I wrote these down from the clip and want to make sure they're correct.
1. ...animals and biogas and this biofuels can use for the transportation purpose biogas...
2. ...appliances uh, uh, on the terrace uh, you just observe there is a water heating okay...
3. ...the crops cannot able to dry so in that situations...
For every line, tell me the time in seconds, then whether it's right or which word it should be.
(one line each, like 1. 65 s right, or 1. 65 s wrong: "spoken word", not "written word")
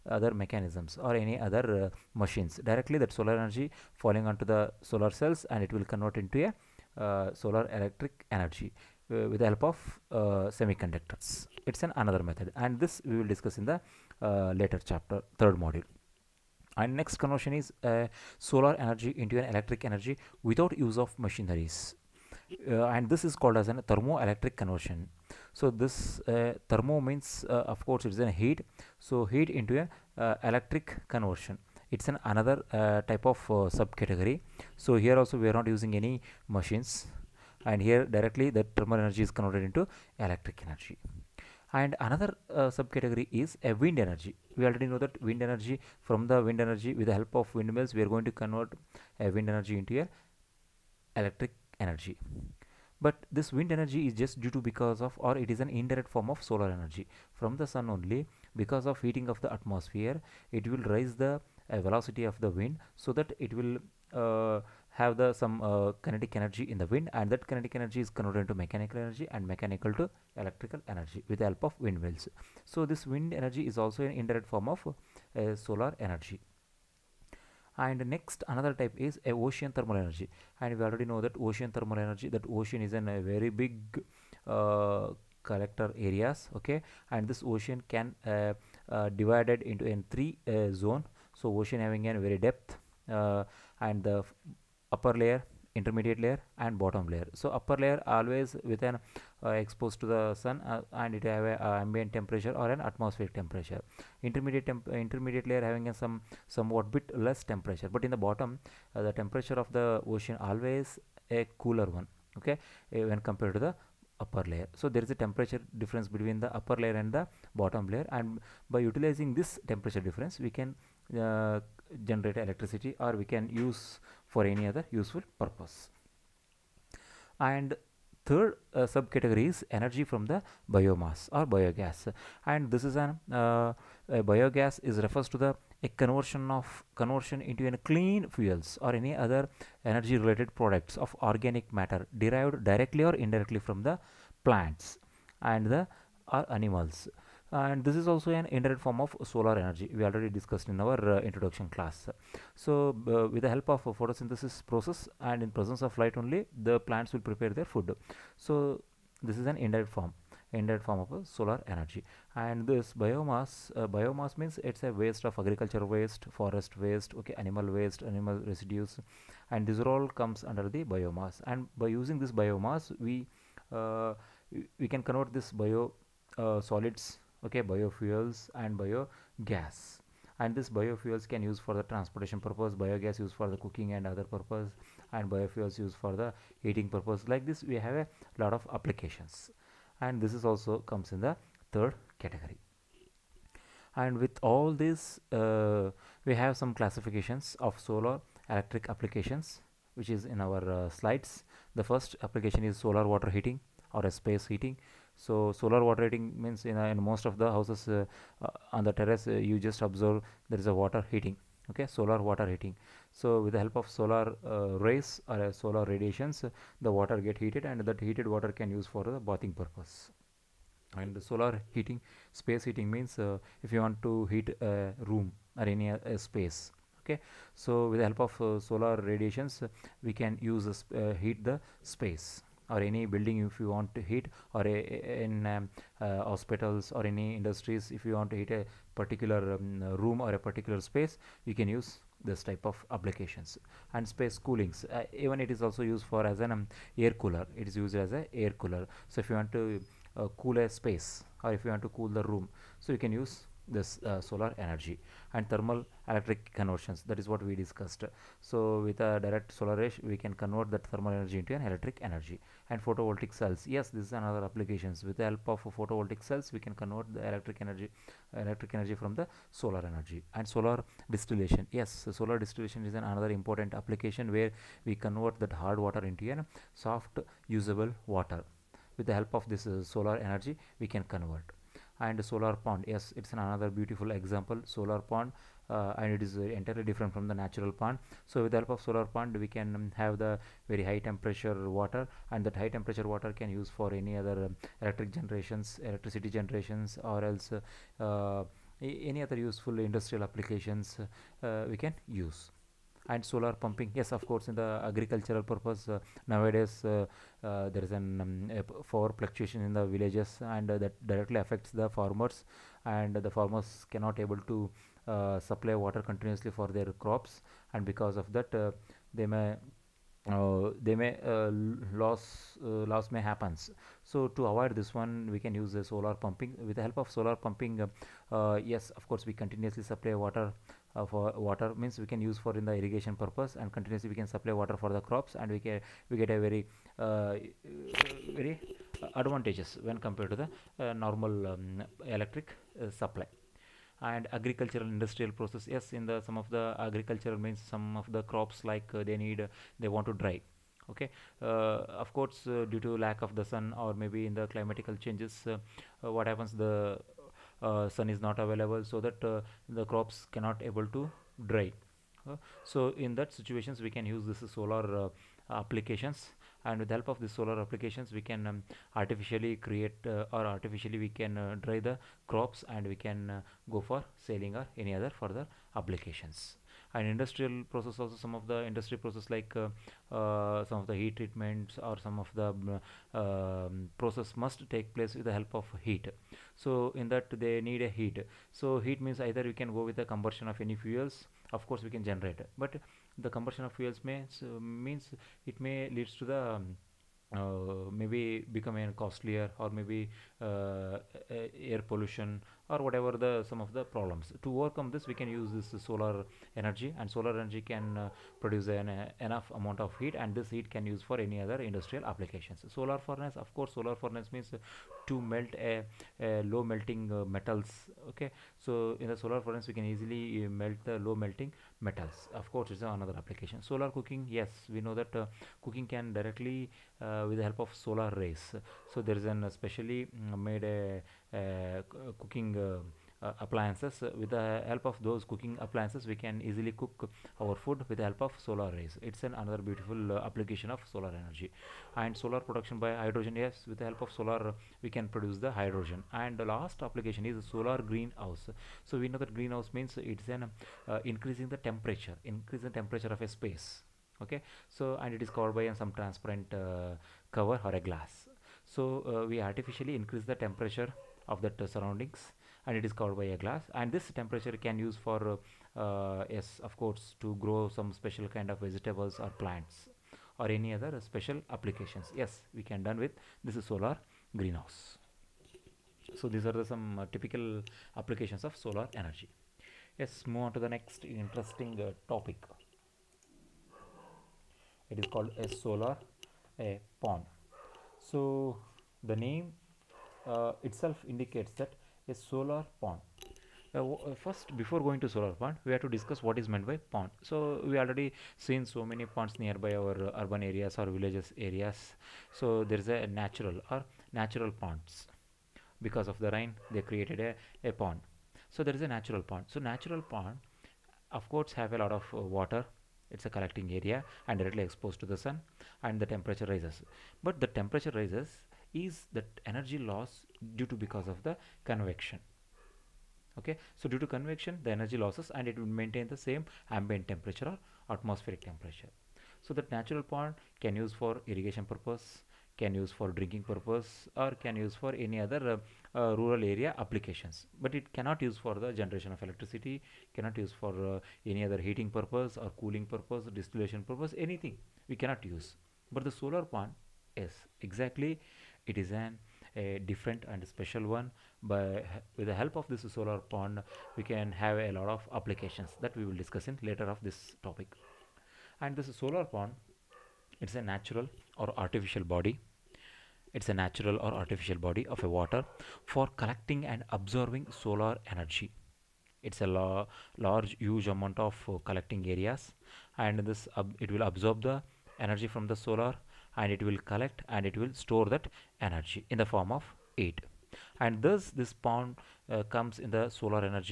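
1. 177 s wrong: "biofuels", not "animals"
2. 207 s wrong: "houses", not "appliances"
3. 359 s right.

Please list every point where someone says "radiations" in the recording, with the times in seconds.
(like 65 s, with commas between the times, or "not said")
215 s, 228 s.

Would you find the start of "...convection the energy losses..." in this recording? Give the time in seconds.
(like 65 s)
524 s.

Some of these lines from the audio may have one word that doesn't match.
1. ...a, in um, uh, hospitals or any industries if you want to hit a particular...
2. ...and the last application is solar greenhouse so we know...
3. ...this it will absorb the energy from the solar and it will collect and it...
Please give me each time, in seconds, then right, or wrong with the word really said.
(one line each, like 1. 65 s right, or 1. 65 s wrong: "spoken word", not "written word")
1. 234 s right
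2. 446 s right
3. 573 s right.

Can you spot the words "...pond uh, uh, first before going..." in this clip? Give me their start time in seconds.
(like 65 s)
492 s.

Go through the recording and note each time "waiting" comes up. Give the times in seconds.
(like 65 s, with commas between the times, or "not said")
not said.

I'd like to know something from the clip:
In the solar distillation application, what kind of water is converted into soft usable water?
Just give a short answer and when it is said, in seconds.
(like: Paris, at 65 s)
hard water, at 275 s.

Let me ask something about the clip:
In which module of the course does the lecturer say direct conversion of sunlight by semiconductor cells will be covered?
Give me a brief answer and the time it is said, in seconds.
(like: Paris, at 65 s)
third module, at 15 s.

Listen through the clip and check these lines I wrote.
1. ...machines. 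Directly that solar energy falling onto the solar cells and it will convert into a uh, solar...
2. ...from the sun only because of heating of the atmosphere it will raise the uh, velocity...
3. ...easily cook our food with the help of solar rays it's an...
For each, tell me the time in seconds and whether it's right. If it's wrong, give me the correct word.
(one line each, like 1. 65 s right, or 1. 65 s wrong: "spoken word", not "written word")
1. 2 s right
2. 57 s right
3. 436 s right.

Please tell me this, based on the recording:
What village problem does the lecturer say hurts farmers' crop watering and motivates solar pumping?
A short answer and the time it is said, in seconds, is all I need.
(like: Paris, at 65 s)
power fluctuation, at 308 s.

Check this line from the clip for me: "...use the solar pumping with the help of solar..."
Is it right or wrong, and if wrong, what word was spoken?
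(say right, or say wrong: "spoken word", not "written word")
right.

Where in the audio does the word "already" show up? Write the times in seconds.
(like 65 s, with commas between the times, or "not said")
44 s, 80 s, 150 s, 497 s.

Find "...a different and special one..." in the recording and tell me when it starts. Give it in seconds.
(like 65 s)
549 s.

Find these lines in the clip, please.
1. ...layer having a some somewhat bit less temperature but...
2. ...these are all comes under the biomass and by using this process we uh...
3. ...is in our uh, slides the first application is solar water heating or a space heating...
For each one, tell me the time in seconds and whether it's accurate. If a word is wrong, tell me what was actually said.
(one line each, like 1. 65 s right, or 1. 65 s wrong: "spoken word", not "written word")
1. 105 s right
2. 169 s wrong: "biomass", not "process"
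3. 200 s right.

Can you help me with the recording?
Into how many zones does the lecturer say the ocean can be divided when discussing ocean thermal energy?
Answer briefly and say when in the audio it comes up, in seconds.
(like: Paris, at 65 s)
3, at 90 s.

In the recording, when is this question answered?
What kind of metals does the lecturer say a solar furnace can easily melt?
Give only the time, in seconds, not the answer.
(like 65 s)
416 s.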